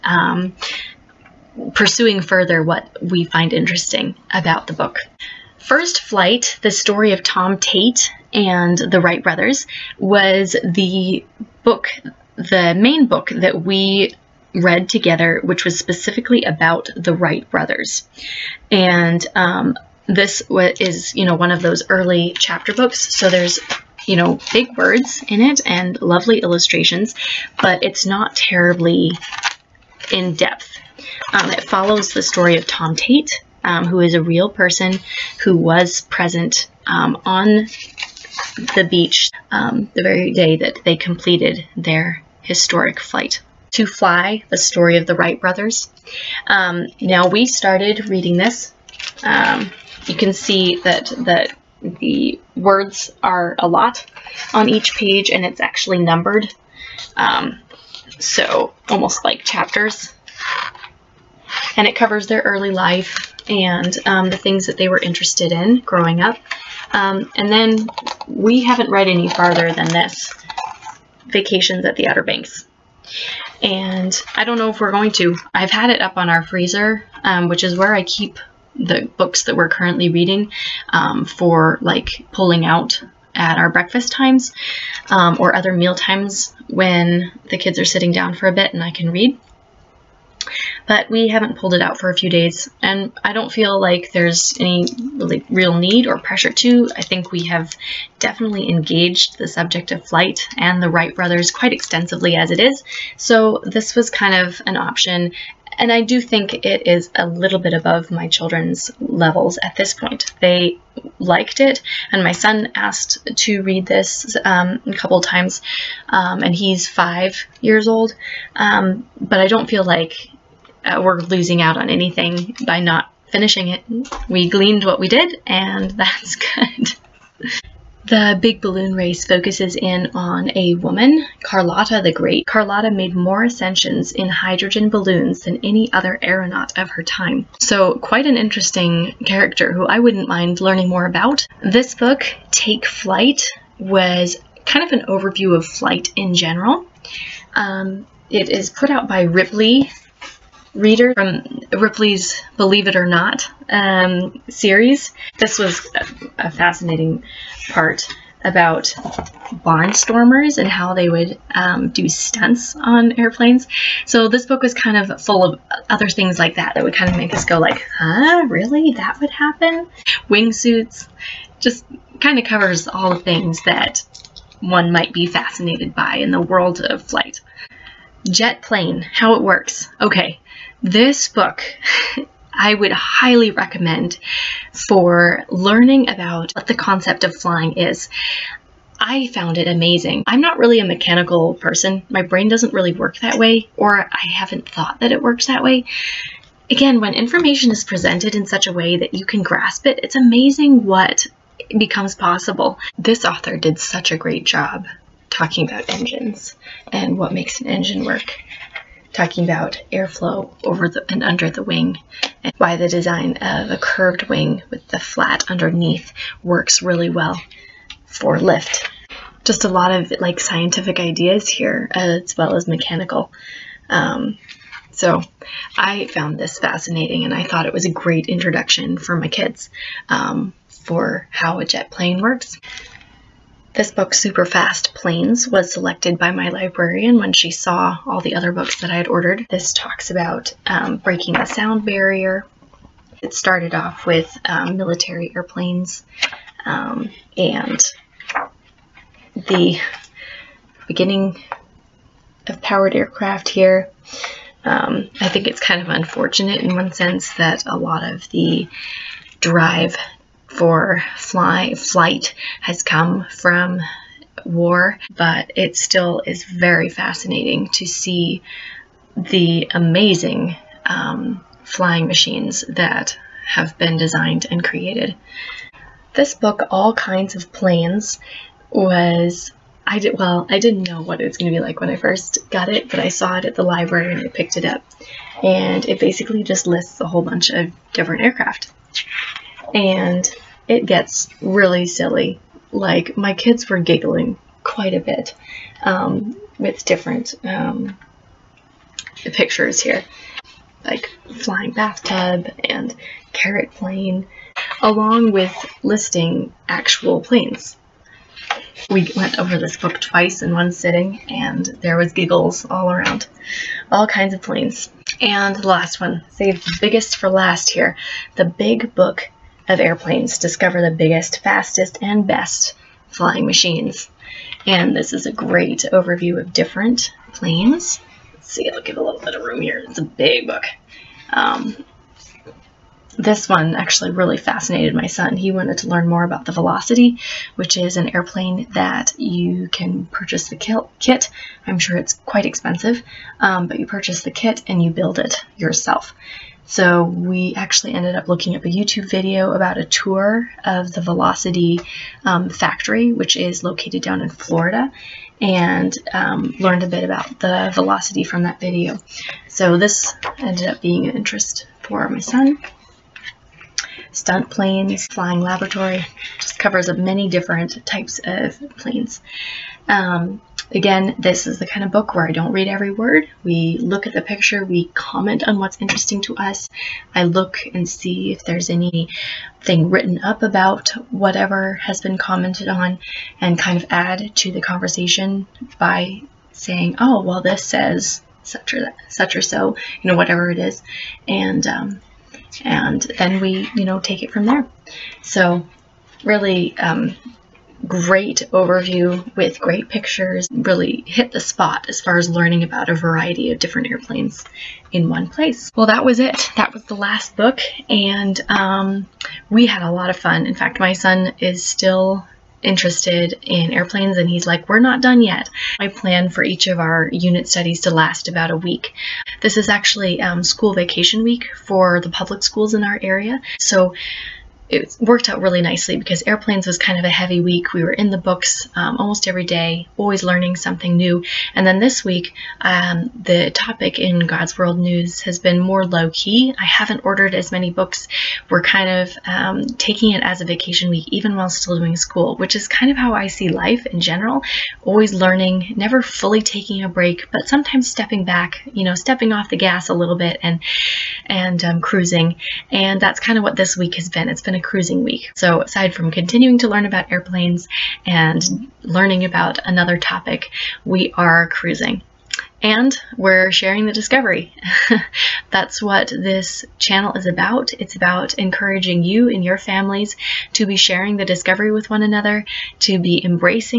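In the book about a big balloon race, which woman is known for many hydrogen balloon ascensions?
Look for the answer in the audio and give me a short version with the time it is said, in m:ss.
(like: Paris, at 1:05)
Carlotta the Great, at 2:11.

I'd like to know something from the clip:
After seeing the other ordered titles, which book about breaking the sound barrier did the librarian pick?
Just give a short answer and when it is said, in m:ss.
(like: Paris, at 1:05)
Super Fast Planes, at 3:54.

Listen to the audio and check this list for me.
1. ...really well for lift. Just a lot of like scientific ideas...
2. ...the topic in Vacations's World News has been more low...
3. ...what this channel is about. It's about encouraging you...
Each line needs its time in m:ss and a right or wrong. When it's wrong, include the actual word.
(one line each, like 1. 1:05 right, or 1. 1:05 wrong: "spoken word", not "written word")
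1. 3:36 right
2. 7:13 wrong: "God", not "Vacations"
3. 7:45 right.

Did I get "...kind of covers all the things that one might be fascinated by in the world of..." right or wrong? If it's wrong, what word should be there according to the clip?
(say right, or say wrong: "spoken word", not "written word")
right.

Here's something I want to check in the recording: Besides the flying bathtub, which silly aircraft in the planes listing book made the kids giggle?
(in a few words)
carrot plane.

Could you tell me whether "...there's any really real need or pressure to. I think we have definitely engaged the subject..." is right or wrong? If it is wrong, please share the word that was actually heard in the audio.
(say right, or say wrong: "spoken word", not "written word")
right.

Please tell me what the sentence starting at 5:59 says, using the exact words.
So this ended up being an interest for my son.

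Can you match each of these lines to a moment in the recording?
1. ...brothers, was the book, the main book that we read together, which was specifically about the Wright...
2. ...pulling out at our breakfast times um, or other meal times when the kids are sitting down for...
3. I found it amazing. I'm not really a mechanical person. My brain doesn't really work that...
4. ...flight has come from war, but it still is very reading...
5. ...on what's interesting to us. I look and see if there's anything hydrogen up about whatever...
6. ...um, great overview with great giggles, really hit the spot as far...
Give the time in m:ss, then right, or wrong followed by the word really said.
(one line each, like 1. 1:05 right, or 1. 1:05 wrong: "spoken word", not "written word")
1. 0:09 right
2. 1:22 right
3. 3:08 right
4. 4:21 wrong: "fascinating", not "reading"
5. 6:15 wrong: "written", not "hydrogen"
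6. 6:36 wrong: "pictures", not "giggles".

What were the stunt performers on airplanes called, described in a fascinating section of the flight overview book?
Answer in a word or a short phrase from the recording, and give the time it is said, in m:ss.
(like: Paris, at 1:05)
barnstormers, at 2:39.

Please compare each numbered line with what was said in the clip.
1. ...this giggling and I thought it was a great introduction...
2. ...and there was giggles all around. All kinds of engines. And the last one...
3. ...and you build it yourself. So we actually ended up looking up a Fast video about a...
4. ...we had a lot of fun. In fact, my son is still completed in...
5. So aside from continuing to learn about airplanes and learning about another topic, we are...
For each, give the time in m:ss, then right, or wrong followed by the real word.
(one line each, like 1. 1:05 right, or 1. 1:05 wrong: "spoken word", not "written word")
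1. 3:46 wrong: "fascinating", not "giggling"
2. 5:11 wrong: "planes", not "engines"
3. 5:44 wrong: "YouTube", not "Fast"
4. 6:49 wrong: "interested", not "completed"
5. 7:35 right.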